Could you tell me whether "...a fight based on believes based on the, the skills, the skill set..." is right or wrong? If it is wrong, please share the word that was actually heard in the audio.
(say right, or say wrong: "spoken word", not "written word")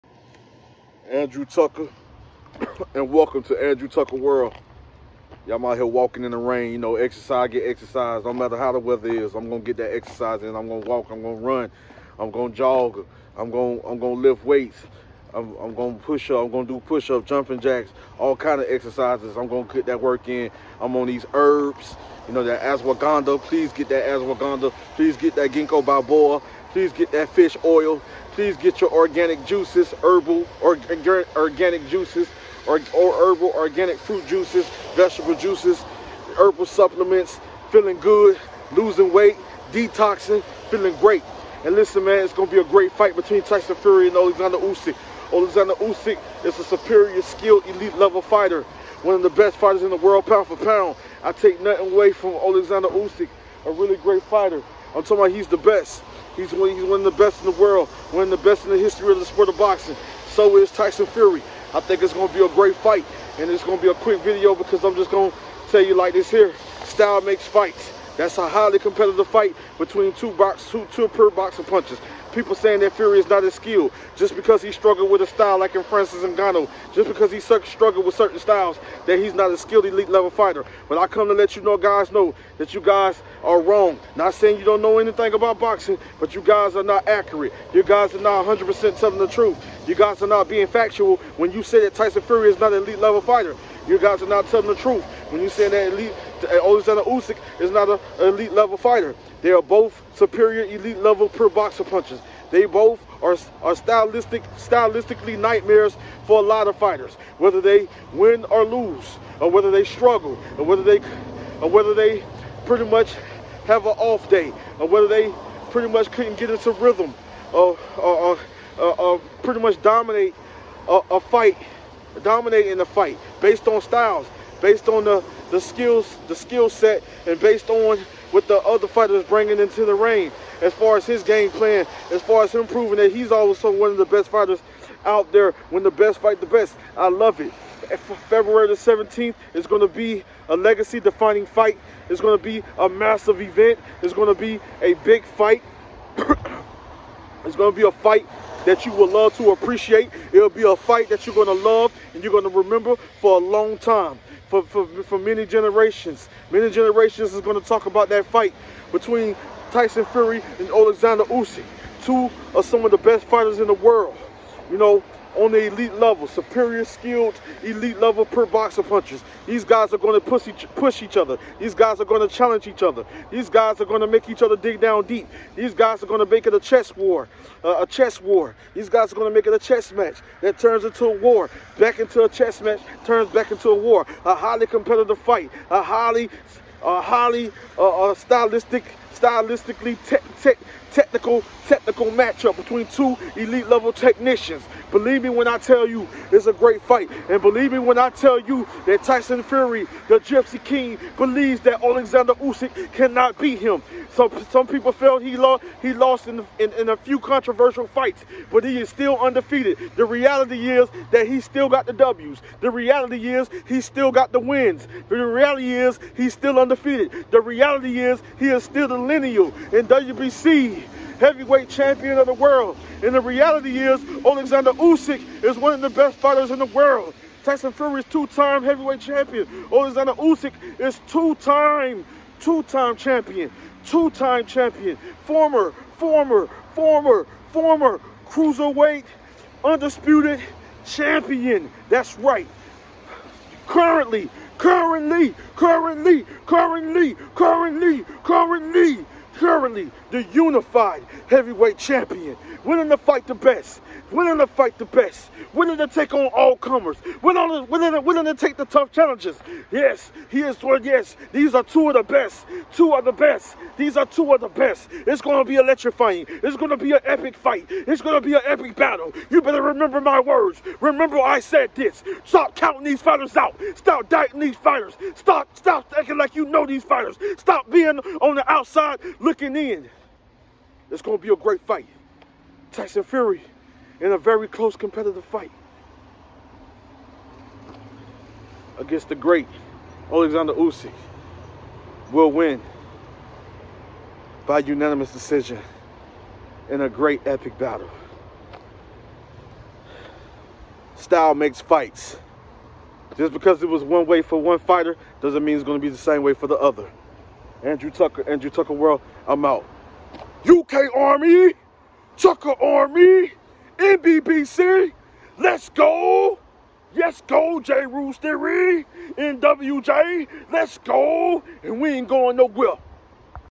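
wrong: "styles", not "believes".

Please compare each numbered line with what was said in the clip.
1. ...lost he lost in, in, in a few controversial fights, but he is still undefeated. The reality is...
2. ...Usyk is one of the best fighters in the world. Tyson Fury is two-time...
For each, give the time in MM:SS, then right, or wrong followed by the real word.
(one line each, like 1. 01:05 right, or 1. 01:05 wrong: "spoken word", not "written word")
1. 03:25 right
2. 03:44 right.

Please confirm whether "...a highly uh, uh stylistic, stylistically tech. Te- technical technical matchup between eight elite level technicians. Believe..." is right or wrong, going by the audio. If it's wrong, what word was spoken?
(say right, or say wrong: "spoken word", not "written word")
wrong: "two", not "eight".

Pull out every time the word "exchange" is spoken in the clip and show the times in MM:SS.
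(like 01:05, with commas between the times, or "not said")
not said.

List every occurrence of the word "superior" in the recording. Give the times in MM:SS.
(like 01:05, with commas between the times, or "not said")
00:46, 01:40, 02:46.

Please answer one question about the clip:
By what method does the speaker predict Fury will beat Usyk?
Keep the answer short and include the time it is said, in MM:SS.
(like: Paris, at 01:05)
unanimous decision, at 04:54.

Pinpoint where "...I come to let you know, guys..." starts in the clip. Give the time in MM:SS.
01:20.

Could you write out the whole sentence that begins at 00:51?
I take nothing away from Alexander Usyk, a really great fighter.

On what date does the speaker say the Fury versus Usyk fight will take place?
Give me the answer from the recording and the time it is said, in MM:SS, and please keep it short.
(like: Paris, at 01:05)
February 17, at 02:18.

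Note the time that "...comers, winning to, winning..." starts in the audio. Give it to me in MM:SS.
04:16.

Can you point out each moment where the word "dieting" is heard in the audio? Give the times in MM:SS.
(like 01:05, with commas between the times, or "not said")
04:34.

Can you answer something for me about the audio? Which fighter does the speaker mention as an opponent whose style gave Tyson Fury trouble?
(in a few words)
Francis Ngannou.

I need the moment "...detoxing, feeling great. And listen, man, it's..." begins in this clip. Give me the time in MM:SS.
00:39.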